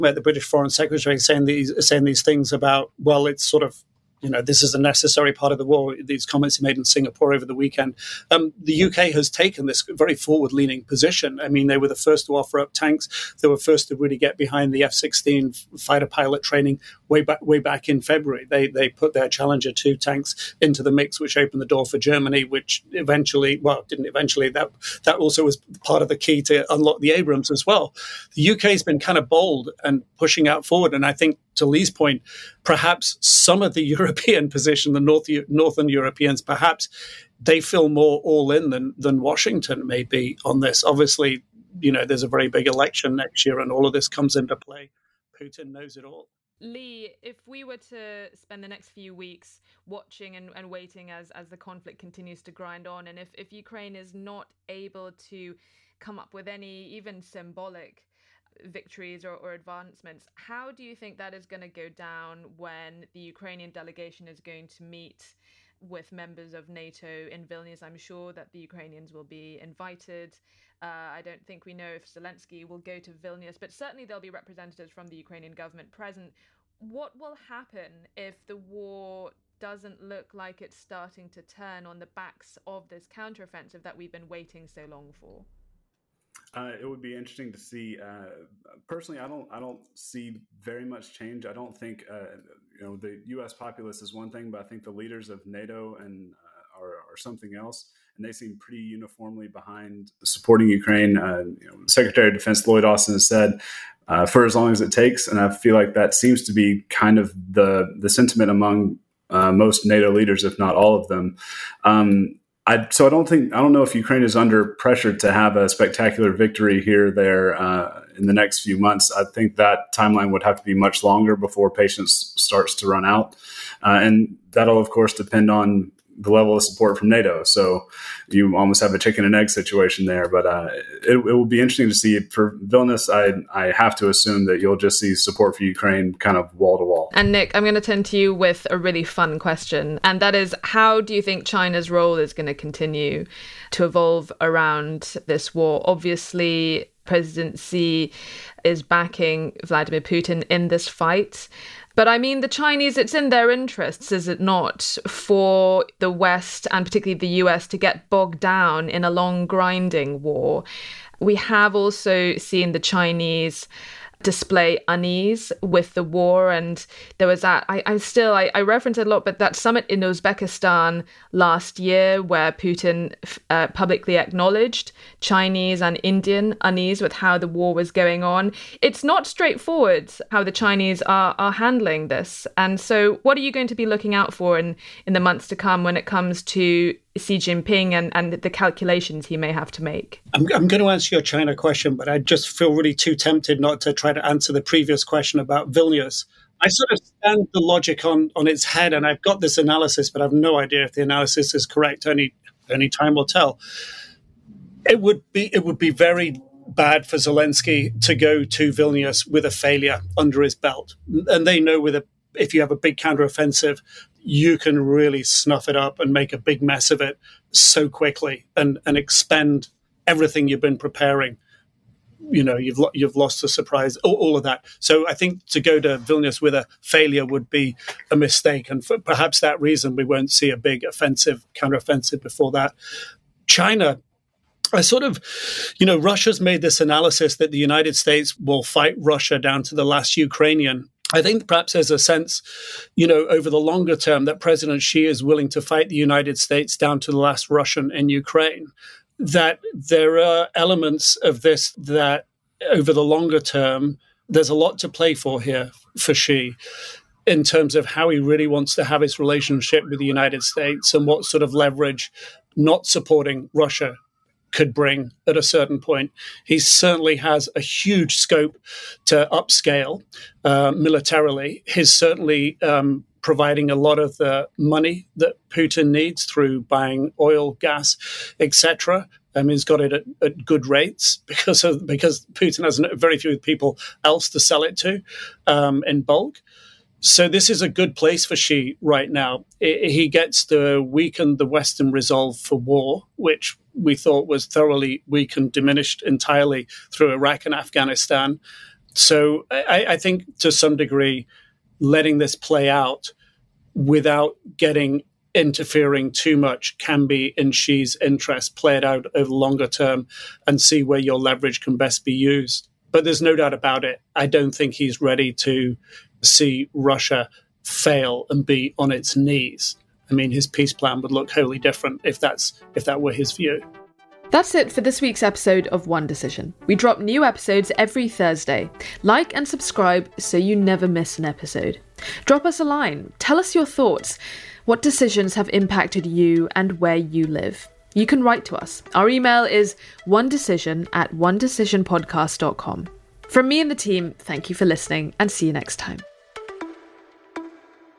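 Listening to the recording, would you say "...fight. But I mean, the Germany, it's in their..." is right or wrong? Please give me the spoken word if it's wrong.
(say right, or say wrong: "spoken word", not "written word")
wrong: "Chinese", not "Germany".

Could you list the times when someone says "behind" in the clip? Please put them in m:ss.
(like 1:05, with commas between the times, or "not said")
0:14, 1:39.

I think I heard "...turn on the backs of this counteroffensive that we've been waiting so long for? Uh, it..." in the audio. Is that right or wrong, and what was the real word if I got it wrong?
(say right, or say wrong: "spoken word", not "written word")
right.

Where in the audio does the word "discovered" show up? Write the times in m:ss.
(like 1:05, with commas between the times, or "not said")
not said.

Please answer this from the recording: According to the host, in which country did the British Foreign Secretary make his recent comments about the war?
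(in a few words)
Singapore.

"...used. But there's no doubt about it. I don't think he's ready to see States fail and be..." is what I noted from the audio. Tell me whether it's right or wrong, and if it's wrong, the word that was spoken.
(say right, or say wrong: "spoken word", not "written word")
wrong: "Russia", not "States".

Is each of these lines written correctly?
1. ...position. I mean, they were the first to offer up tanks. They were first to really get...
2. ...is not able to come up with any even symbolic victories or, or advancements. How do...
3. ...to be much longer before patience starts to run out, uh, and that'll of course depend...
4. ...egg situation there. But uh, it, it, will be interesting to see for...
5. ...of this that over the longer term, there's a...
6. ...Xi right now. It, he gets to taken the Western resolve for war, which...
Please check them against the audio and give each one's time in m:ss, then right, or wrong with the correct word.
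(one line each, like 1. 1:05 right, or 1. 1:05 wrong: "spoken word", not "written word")
1. 0:10 right
2. 0:53 right
3. 2:00 right
4. 2:09 right
5. 4:11 right
6. 4:48 wrong: "weaken", not "taken".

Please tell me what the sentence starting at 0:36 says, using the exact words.
Perhaps they feel more all in than, than Washington may be on this.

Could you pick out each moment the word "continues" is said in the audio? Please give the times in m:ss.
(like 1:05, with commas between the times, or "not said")
0:51, 2:22.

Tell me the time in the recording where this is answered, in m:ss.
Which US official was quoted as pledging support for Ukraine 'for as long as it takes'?
1:42.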